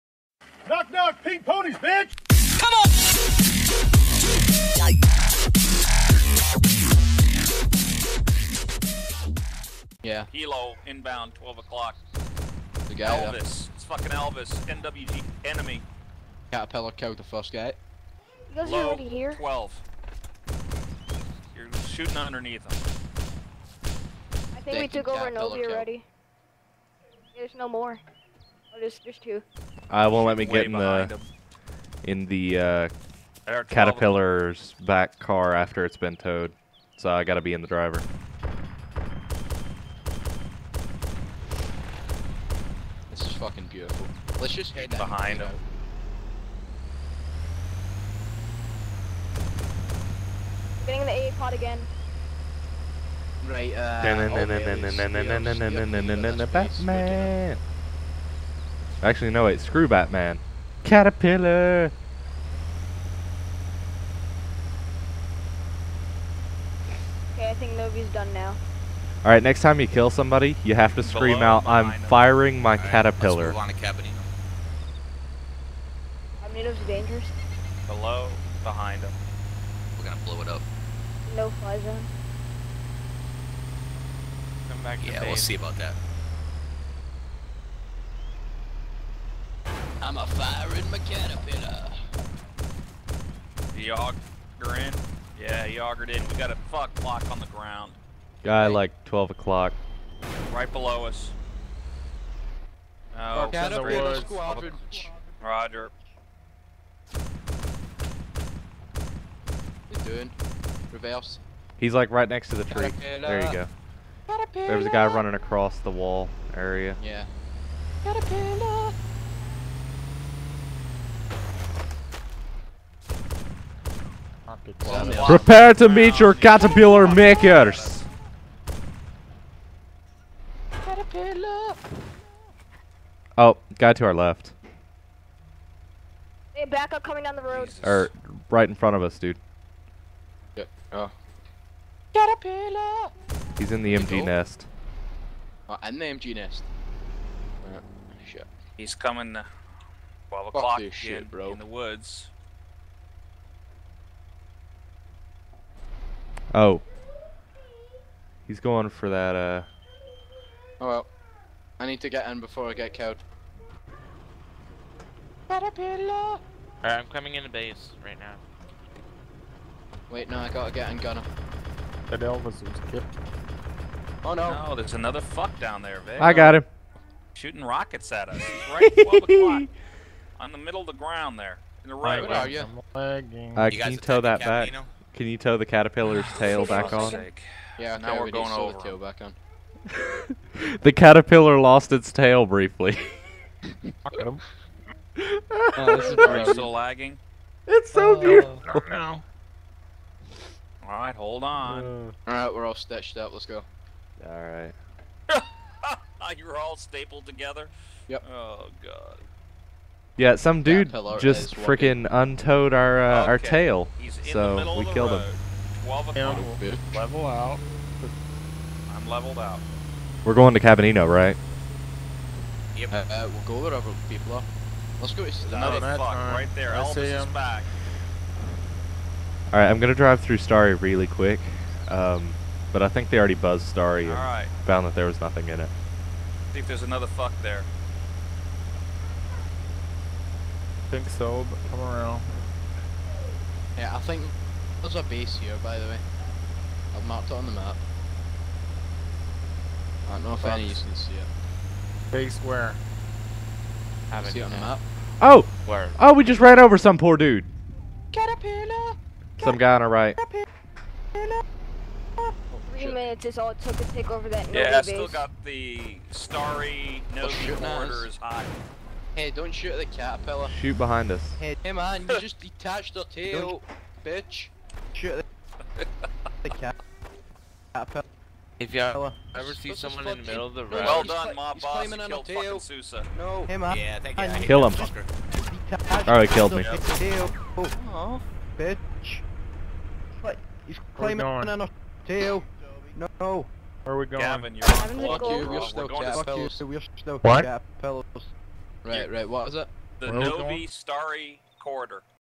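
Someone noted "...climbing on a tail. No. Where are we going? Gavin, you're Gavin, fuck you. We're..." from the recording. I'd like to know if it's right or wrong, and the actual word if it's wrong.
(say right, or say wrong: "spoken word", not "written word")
right.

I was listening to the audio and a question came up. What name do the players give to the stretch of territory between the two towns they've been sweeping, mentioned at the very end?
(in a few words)
The Novy Stary Corridor.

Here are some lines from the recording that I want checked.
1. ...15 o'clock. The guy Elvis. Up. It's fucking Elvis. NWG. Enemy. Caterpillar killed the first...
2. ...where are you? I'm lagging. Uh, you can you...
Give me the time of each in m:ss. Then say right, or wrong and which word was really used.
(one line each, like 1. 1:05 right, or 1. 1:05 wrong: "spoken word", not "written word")
1. 0:11 wrong: "12", not "15"
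2. 3:02 right.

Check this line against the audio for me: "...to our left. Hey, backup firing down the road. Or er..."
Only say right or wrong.
wrong.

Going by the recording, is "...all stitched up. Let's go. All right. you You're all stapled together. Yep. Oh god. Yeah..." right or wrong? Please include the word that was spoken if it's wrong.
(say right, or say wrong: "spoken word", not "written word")
right.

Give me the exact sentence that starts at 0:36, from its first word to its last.
So I gotta be in the driver.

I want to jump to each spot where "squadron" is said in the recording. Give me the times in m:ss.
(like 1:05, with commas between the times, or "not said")
1:44.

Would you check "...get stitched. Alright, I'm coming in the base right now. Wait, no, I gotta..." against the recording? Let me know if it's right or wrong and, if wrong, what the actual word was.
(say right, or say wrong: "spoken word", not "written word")
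wrong: "killed", not "stitched".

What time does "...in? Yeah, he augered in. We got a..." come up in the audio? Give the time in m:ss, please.
1:34.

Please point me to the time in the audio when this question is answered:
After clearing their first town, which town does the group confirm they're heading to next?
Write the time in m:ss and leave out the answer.
3:40.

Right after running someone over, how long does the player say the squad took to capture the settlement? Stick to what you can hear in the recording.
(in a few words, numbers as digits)
Three minutes.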